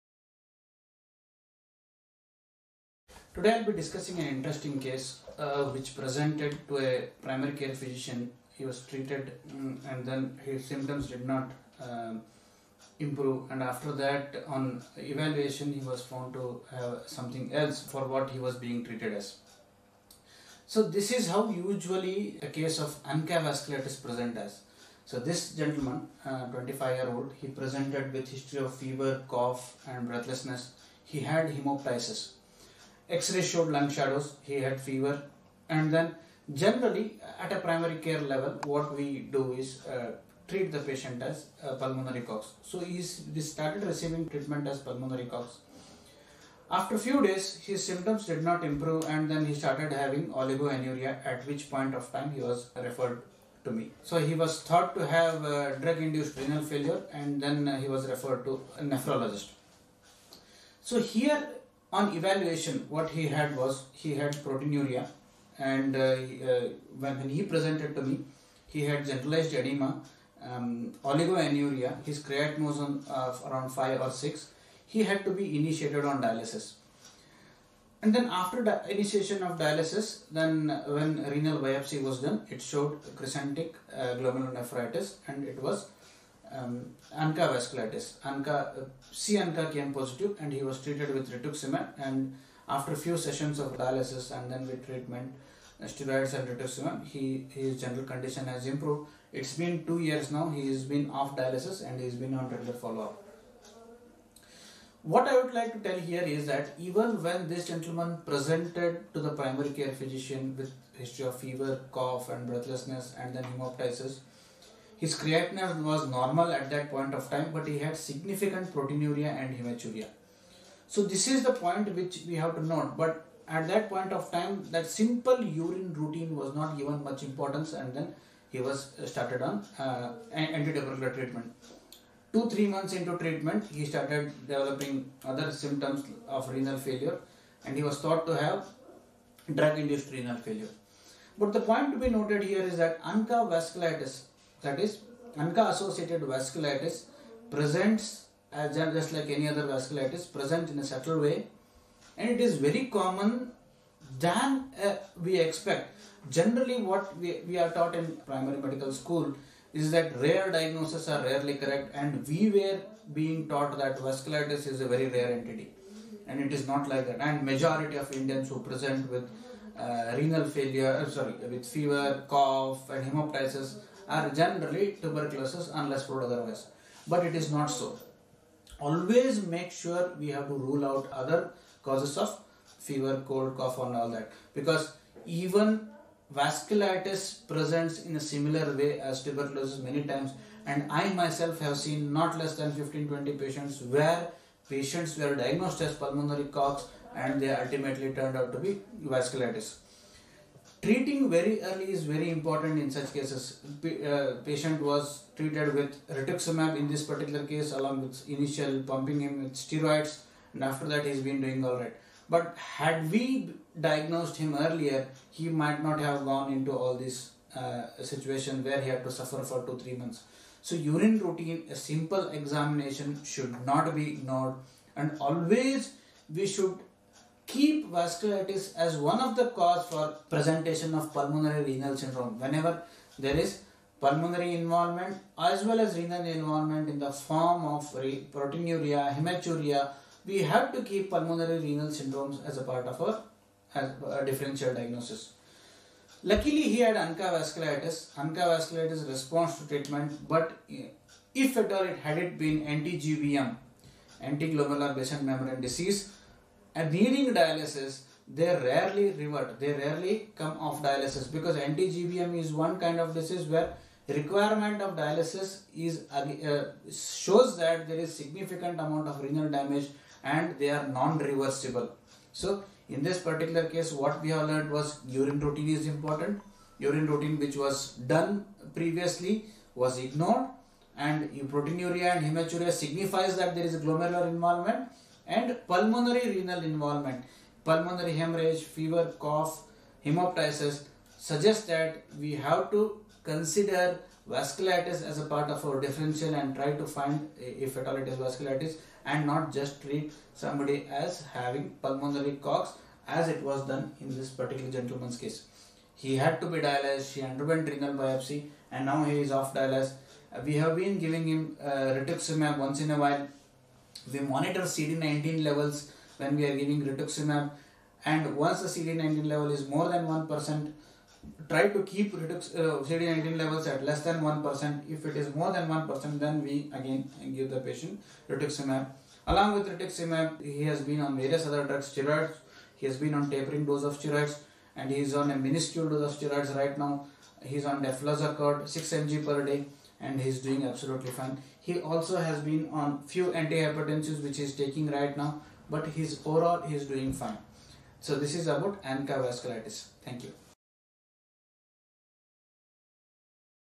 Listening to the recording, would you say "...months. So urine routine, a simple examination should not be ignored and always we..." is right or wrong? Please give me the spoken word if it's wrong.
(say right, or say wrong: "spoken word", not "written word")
right.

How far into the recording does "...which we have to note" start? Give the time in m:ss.
2:01.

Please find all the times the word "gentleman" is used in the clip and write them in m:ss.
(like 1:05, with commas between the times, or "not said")
0:25, 1:47, 5:04.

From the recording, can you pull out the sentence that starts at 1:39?
It's been two years now, he has been off dialysis and he's been on regular follow-up.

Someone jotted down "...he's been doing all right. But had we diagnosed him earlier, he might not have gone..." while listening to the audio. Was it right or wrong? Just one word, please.
right.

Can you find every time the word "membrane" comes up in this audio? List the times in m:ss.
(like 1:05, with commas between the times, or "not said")
4:15.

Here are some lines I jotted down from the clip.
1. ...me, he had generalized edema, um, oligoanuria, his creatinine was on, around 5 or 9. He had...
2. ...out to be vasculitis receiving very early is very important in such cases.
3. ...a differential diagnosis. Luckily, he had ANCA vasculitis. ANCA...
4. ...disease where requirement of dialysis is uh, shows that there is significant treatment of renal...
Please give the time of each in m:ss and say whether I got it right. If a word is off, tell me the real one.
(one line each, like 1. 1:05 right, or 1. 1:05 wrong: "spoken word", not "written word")
1. 1:08 wrong: "6", not "9"
2. 3:18 wrong: "treating", not "receiving"
3. 4:04 right
4. 4:23 wrong: "amount", not "treatment".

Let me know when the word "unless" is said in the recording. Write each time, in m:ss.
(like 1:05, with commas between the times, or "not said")
2:55.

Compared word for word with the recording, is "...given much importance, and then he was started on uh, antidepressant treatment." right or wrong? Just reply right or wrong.
right.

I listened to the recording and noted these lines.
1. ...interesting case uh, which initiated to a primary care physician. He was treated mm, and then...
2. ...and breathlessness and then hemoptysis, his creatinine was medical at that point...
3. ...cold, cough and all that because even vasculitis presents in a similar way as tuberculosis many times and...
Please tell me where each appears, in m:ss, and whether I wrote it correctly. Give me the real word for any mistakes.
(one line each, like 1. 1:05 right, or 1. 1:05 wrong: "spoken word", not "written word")
1. 0:04 wrong: "presented", not "initiated"
2. 1:52 wrong: "normal", not "medical"
3. 3:03 right.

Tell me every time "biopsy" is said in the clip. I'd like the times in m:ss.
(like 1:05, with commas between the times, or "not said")
1:21, 5:07.